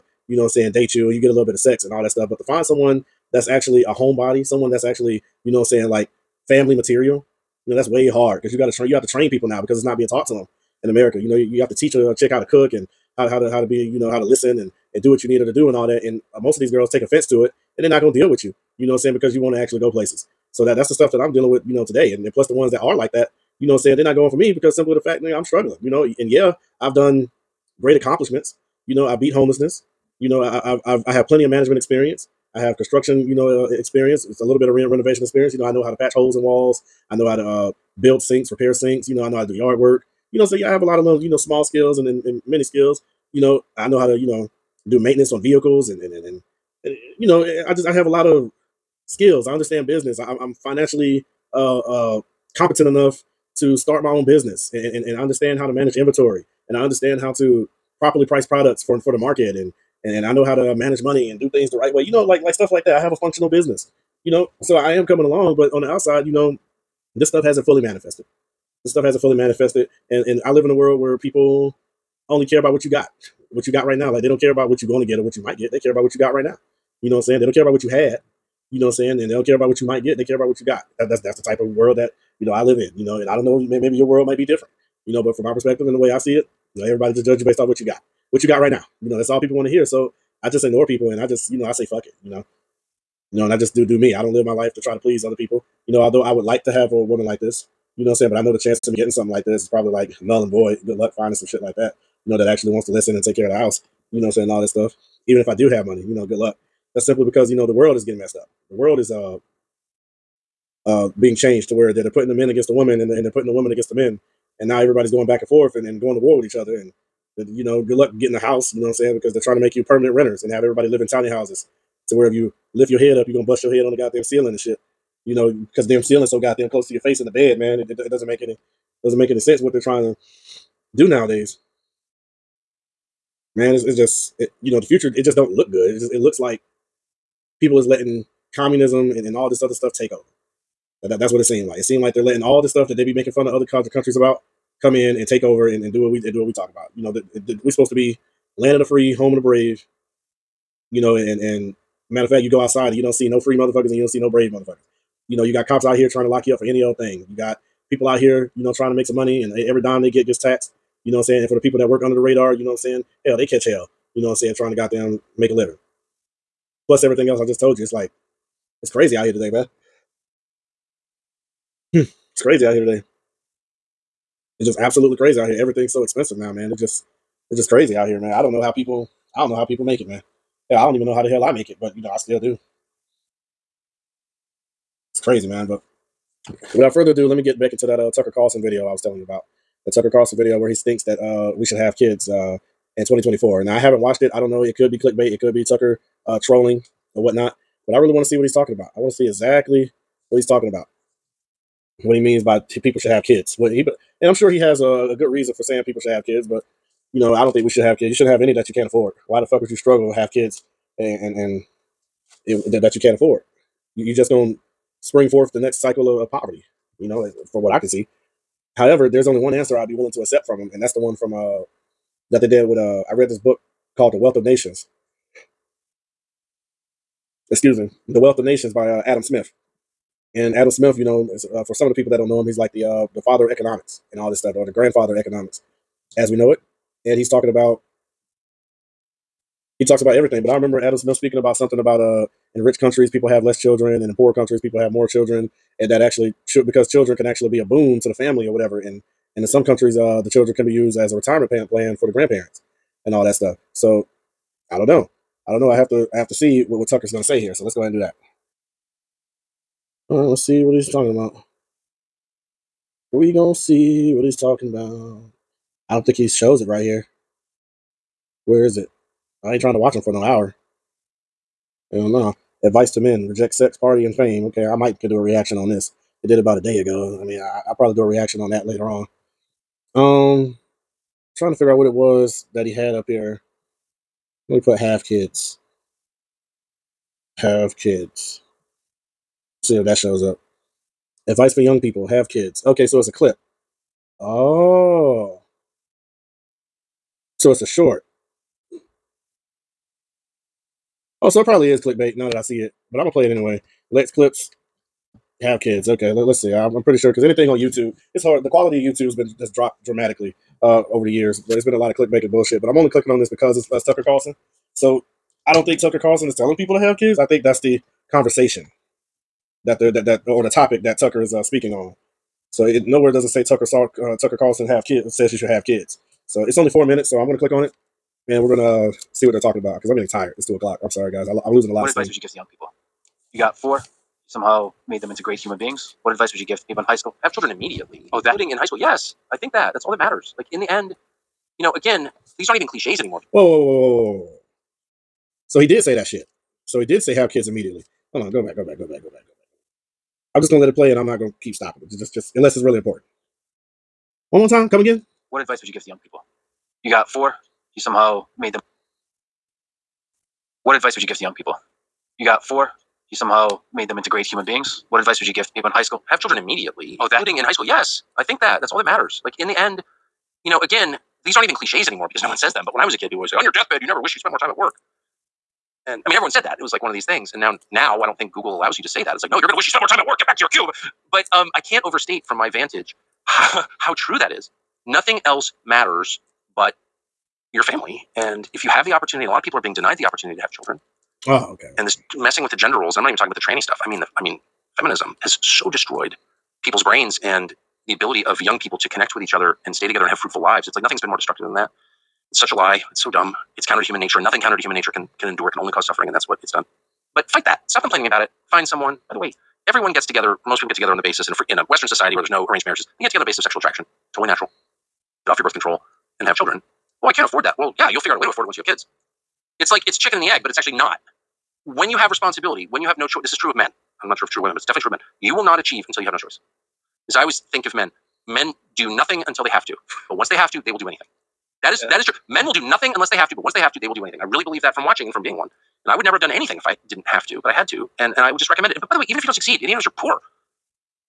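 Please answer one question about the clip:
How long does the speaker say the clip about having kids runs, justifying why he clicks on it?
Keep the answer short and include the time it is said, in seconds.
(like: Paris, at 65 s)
4 minutes, at 326 s.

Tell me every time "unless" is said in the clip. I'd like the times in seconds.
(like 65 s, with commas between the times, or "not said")
352 s, 432 s.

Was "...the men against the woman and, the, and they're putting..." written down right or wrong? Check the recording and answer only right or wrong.
right.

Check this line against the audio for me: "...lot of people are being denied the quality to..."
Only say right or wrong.
wrong.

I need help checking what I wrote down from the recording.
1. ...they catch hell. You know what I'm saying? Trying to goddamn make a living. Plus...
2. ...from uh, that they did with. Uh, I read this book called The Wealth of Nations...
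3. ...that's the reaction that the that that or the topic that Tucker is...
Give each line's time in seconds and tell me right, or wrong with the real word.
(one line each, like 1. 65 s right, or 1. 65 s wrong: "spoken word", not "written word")
1. 163 s right
2. 221 s right
3. 317 s wrong: "conversation", not "reaction".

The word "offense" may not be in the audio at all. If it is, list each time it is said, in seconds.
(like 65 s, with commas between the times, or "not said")
17 s.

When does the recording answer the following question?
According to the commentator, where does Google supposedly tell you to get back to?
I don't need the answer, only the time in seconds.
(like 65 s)
380 s.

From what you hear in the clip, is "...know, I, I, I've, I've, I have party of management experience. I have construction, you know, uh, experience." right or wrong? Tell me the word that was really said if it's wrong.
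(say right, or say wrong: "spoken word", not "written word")
wrong: "plenty", not "party".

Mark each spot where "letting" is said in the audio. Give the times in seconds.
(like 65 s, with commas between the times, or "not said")
137 s, 142 s.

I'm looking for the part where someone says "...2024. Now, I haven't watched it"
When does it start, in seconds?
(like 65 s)
193 s.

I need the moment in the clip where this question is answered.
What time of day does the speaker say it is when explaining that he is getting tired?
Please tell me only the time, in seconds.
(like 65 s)
330 s.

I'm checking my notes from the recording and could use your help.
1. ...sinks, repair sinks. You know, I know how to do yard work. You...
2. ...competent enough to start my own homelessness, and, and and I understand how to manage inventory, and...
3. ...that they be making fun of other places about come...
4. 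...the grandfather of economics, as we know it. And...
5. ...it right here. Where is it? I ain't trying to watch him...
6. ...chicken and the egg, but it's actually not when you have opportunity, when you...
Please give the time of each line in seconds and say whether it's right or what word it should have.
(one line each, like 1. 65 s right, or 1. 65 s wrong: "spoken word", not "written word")
1. 38 s right
2. 52 s wrong: "business", not "homelessness"
3. 142 s wrong: "countries", not "places"
4. 234 s right
5. 266 s right
6. 419 s wrong: "responsibility", not "opportunity".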